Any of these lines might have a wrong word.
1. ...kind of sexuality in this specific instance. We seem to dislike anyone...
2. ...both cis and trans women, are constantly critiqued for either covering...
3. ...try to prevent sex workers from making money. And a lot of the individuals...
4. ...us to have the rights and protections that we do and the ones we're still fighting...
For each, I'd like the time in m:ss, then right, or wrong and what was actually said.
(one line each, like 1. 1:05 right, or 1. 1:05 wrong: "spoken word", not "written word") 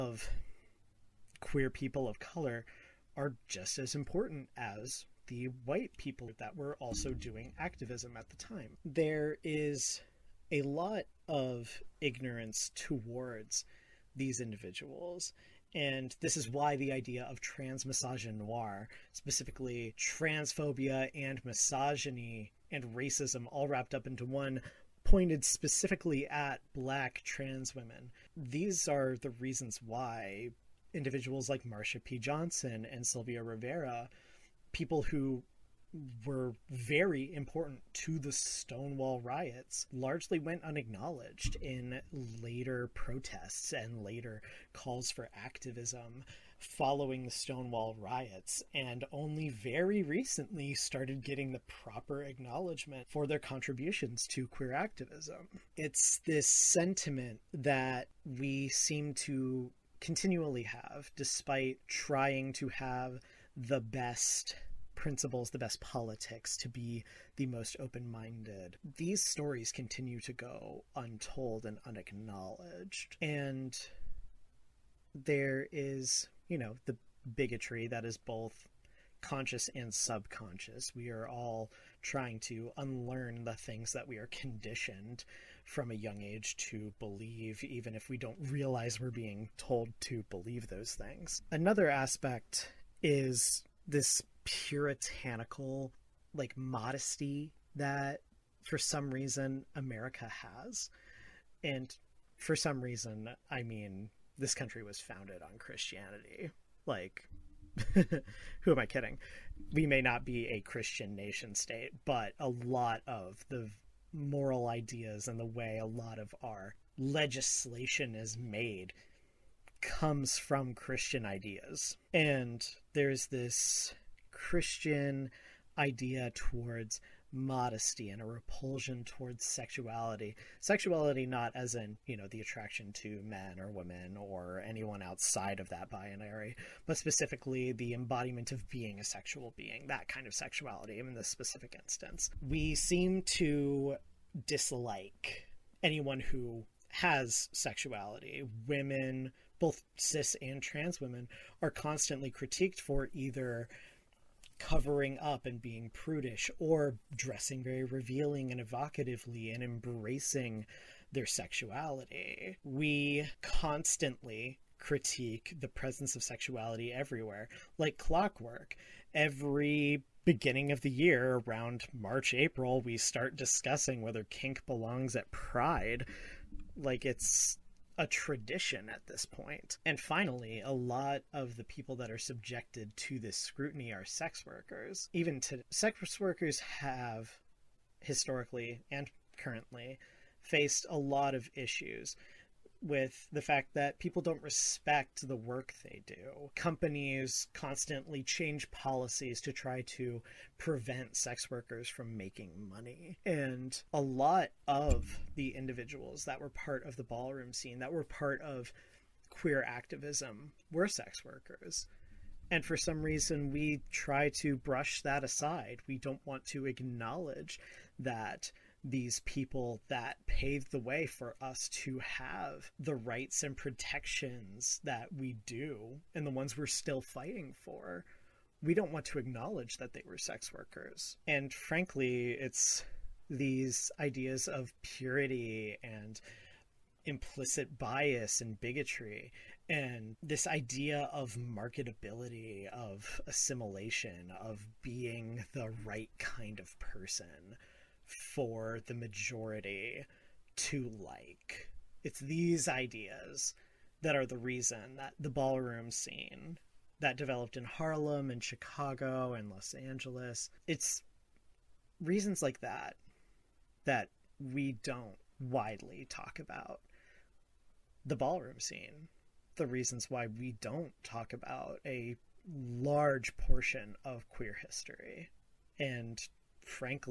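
1. 2:20 right
2. 2:29 right
3. 3:19 right
4. 3:41 right.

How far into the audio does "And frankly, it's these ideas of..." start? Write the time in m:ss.
3:51.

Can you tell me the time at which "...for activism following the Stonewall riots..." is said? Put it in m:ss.
0:45.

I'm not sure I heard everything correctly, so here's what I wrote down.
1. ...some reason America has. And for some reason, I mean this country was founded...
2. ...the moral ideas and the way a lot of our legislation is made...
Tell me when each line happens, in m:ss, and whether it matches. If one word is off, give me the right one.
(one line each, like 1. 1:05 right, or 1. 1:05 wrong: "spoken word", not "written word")
1. 1:38 right
2. 1:53 right.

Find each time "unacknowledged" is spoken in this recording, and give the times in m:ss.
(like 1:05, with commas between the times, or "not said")
0:40, 1:11.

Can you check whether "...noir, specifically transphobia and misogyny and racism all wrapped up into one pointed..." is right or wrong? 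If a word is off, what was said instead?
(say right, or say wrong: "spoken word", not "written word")
right.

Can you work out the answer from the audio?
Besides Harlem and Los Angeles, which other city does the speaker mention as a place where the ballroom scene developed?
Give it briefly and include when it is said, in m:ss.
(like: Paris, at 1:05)
Chicago, at 4:18.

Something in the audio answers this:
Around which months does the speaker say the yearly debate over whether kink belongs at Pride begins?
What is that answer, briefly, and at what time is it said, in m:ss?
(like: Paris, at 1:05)
March, April, at 2:51.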